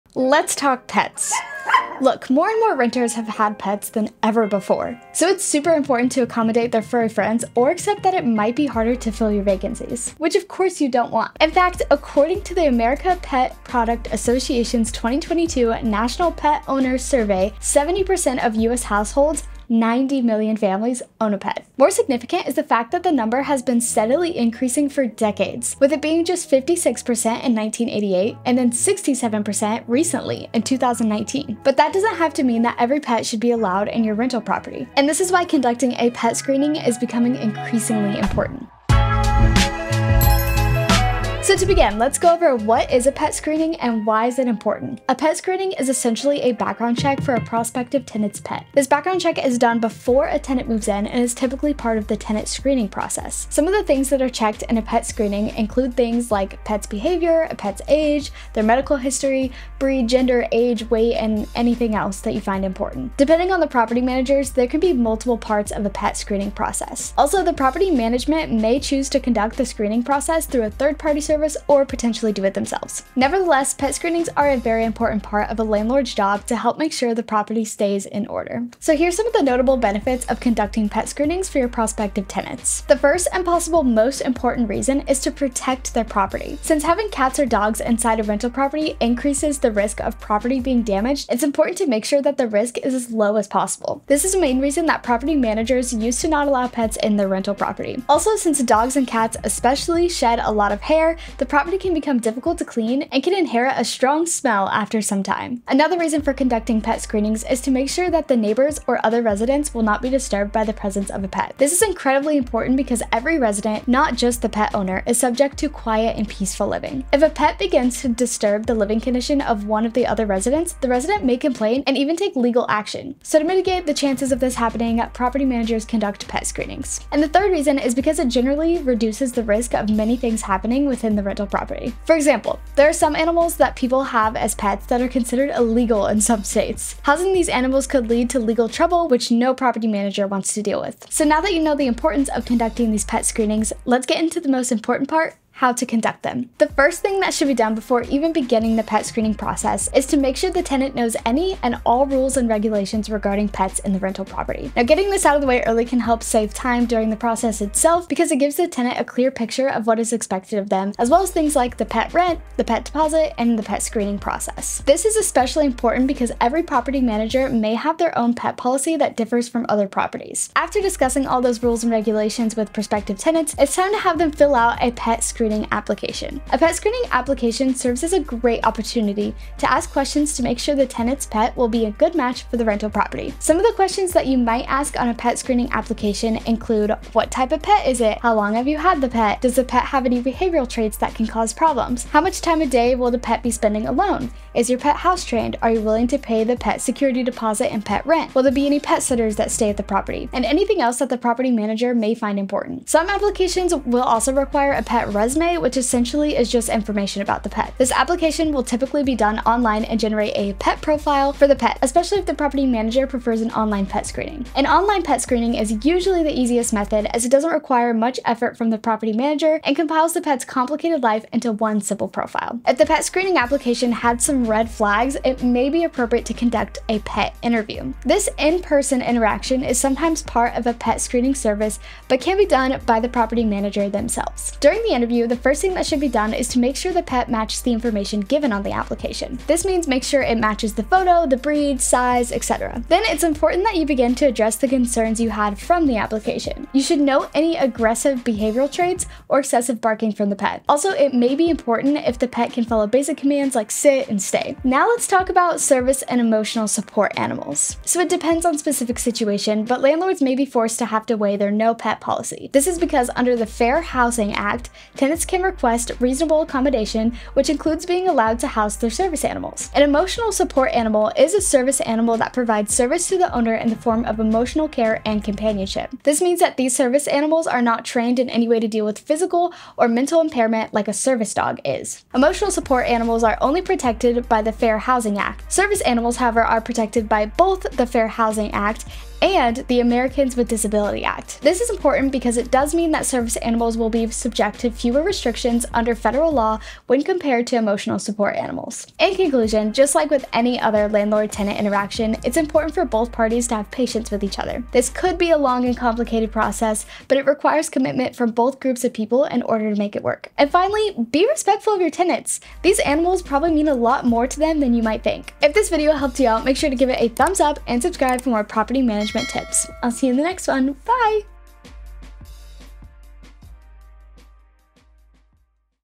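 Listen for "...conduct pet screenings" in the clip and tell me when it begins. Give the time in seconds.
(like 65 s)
125 s.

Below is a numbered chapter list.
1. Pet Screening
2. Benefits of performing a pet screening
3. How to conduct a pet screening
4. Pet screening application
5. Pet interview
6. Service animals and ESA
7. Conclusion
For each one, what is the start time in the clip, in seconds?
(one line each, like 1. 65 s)
1. 41 s
2. 79 s
3. 142 s
4. 170 s
5. 223 s
6. 254 s
7. 299 s.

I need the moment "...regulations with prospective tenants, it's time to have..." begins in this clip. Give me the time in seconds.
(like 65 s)
171 s.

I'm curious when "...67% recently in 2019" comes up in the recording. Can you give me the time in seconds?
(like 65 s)
28 s.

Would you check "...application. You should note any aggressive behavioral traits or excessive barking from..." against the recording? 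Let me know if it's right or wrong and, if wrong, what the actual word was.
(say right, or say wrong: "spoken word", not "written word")
right.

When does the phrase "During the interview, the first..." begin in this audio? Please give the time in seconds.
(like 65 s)
234 s.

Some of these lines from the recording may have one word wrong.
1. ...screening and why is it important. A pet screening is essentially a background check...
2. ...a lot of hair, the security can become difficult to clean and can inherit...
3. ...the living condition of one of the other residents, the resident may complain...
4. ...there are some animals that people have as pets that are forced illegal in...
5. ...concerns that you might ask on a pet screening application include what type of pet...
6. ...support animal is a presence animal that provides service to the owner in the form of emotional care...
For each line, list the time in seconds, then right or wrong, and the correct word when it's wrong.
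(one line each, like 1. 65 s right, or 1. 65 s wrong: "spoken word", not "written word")
1. 43 s right
2. 100 s wrong: "property", not "security"
3. 118 s right
4. 132 s wrong: "considered", not "forced"
5. 183 s wrong: "questions", not "concerns"
6. 270 s wrong: "service", not "presence".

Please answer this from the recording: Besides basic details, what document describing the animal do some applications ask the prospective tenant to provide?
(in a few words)
pet resident resume.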